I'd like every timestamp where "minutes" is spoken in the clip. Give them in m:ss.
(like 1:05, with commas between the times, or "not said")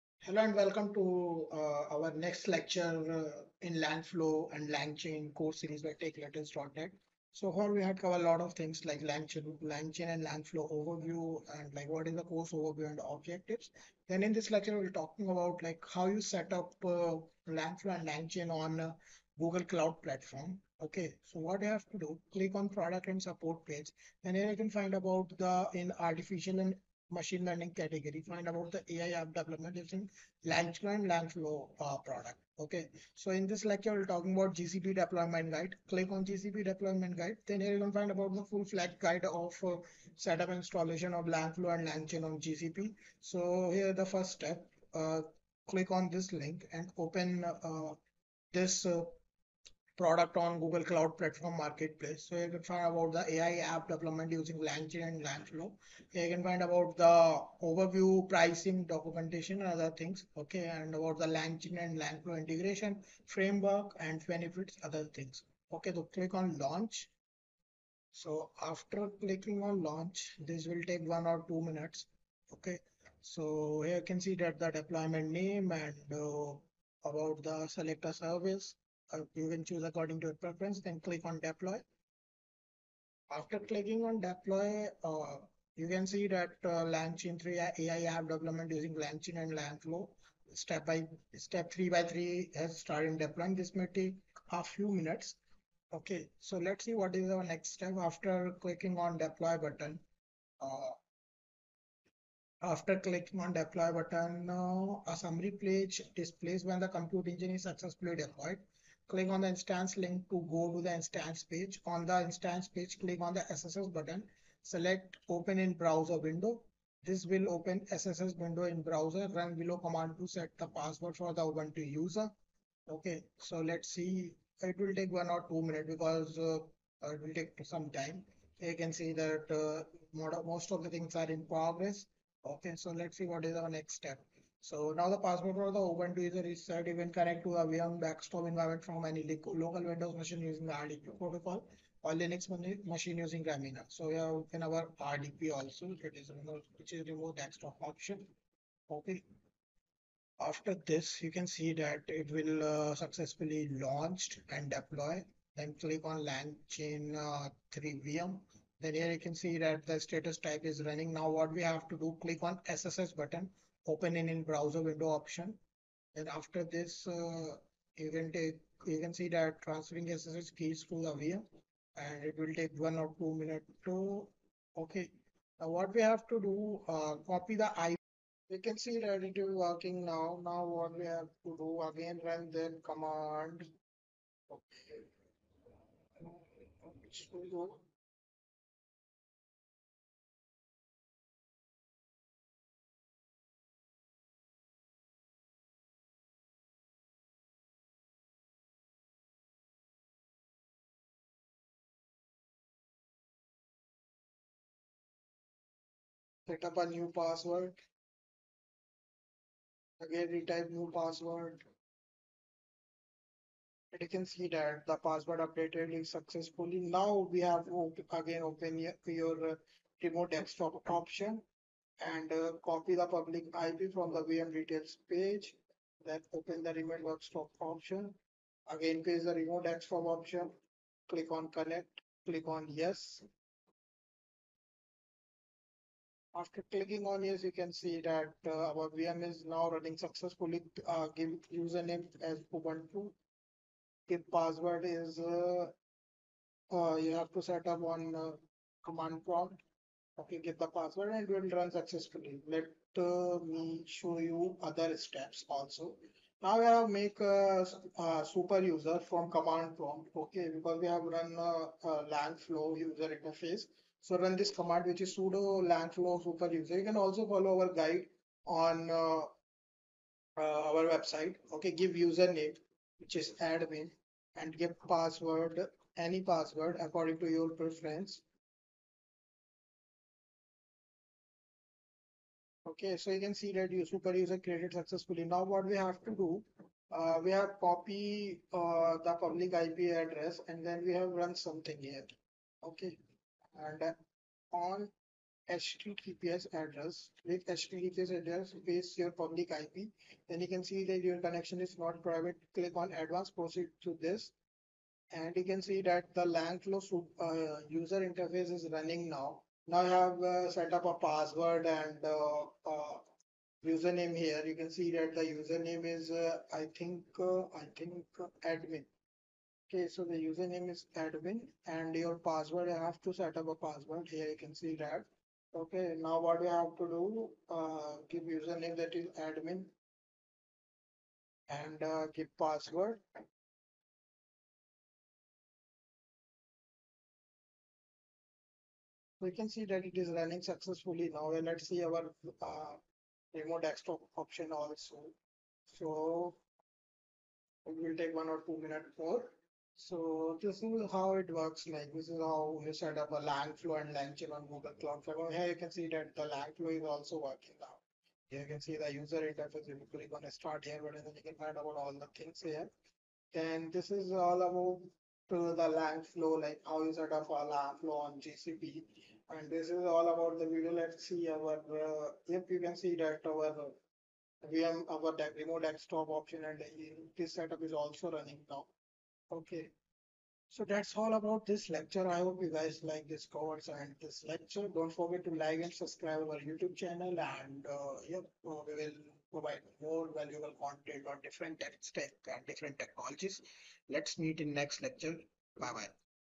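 1:11, 1:34, 2:05, 2:53, 5:48.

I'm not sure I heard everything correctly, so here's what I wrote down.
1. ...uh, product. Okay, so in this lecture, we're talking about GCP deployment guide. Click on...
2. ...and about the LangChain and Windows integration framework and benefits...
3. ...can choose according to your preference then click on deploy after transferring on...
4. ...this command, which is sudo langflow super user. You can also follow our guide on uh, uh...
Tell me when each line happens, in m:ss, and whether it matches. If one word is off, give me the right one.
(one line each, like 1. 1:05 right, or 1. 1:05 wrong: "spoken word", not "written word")
1. 0:31 right
2. 1:00 wrong: "LangFlow", not "Windows"
3. 1:19 wrong: "clicking", not "transferring"
4. 4:24 right.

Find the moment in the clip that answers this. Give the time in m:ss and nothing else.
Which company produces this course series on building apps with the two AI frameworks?
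0:06.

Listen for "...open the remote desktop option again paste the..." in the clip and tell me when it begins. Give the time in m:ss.
3:46.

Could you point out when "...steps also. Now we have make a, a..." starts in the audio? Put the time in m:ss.
4:14.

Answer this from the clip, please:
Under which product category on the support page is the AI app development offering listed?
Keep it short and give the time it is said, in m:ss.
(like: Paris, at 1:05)
artificial and machine learning, at 0:25.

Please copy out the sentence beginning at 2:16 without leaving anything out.
even connect to a VM backstop environment from any local Windows machine using the RDP protocol or Linux machine using Remmina.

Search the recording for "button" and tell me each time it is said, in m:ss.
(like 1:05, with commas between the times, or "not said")
1:39, 1:43, 1:53, 2:43.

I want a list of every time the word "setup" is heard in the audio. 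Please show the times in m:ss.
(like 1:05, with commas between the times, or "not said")
0:40, 6:17.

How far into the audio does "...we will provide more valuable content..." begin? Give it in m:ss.
6:28.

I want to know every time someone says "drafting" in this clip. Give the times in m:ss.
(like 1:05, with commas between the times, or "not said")
not said.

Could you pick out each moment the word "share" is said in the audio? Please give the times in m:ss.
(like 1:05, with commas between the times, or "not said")
not said.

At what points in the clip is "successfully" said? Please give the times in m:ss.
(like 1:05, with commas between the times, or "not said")
1:47, 2:32, 3:36, 3:59, 4:11, 4:44, 5:40.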